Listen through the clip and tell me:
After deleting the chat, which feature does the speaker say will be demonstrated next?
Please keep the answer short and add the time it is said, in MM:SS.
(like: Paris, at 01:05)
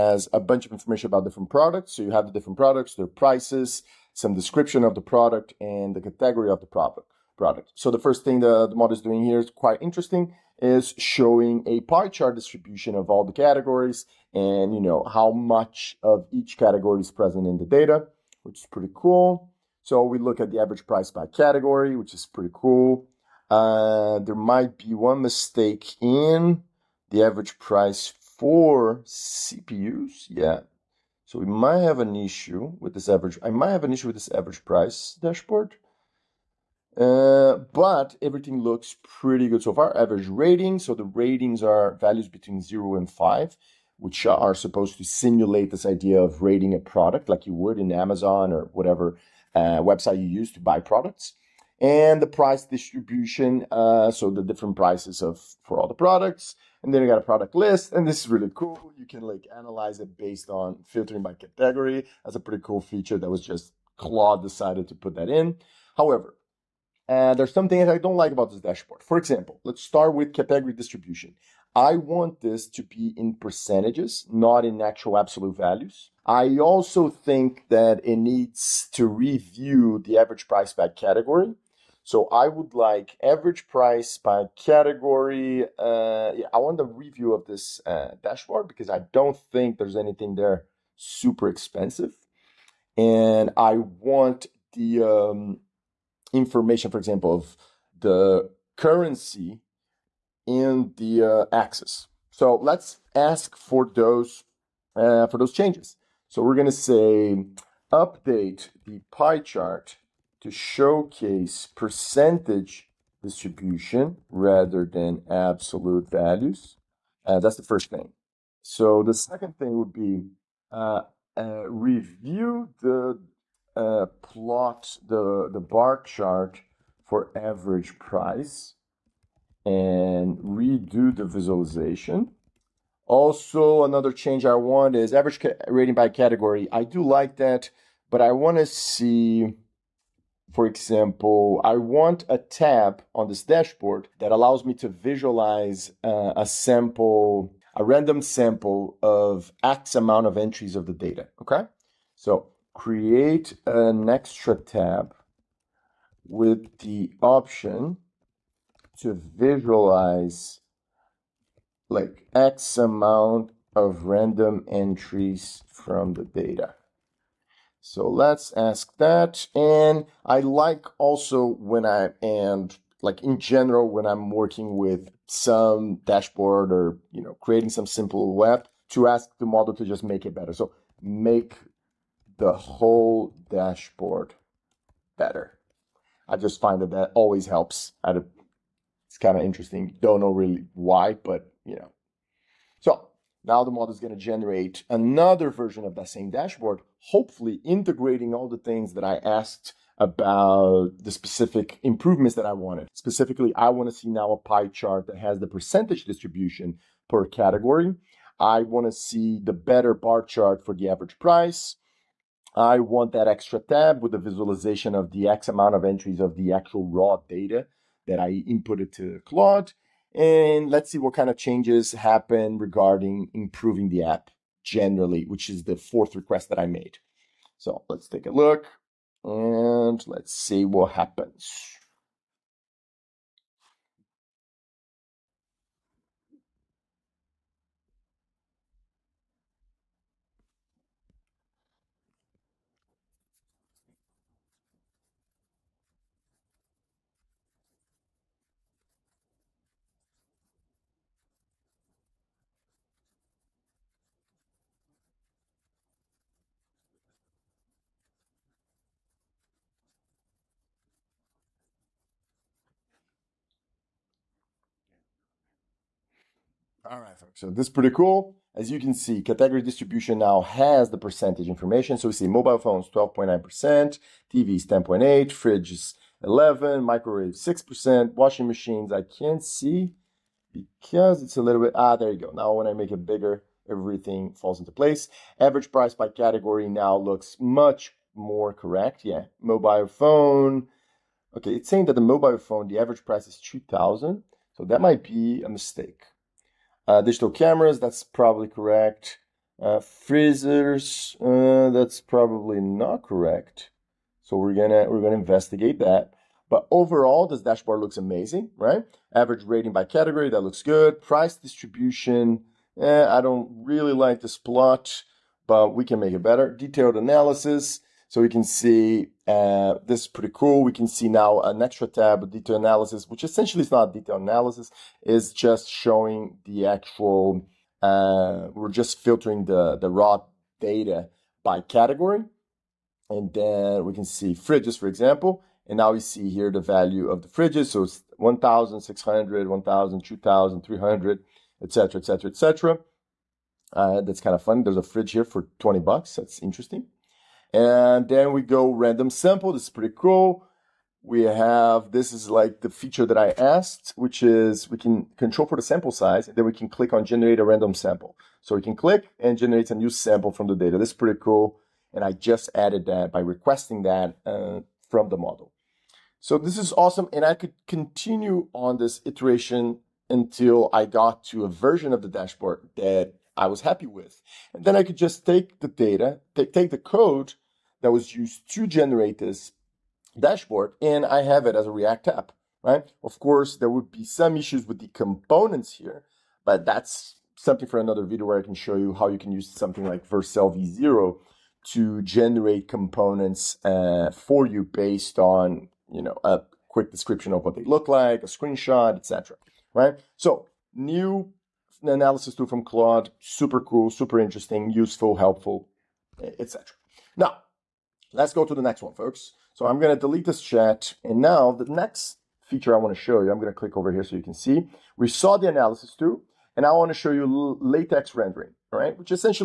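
LaTeX rendering, at 06:57.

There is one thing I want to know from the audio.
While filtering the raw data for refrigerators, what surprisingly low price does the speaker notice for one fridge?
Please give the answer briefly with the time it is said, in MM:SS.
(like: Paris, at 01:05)
20 bucks, at 05:45.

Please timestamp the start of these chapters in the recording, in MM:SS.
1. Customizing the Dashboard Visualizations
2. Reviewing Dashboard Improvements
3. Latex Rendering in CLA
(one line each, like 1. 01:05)
1. 01:54
2. 04:26
3. 06:49.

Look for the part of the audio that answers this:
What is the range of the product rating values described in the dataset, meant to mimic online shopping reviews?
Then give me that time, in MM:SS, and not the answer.
00:42.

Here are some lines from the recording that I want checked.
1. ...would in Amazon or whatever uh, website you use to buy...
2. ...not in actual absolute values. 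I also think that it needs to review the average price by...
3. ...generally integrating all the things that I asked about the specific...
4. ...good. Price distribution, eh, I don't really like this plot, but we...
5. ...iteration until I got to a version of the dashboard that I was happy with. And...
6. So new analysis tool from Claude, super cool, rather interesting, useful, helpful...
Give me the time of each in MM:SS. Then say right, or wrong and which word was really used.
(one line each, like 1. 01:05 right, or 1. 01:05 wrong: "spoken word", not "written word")
1. 00:47 right
2. 01:14 right
3. 03:16 wrong: "hopefully", not "generally"
4. 05:10 right
5. 06:09 right
6. 06:40 wrong: "super", not "rather".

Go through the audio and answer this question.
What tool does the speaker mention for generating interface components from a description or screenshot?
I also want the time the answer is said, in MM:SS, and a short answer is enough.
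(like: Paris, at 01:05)
Vercel v0, at 06:30.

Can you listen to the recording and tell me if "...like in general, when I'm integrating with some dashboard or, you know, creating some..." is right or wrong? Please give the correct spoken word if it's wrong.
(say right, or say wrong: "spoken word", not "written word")
wrong: "working", not "integrating".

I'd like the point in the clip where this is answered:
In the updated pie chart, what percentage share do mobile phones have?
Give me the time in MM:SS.
04:32.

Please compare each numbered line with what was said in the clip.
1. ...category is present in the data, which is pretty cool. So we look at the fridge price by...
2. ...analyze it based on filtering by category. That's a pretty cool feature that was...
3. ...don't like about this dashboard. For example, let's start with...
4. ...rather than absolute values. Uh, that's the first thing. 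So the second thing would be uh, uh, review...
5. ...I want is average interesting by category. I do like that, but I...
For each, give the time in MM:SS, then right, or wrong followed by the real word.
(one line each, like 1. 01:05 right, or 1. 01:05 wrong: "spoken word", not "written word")
1. 00:16 wrong: "average", not "fridge"
2. 00:59 right
3. 01:07 right
4. 01:54 right
5. 02:14 wrong: "rating", not "interesting".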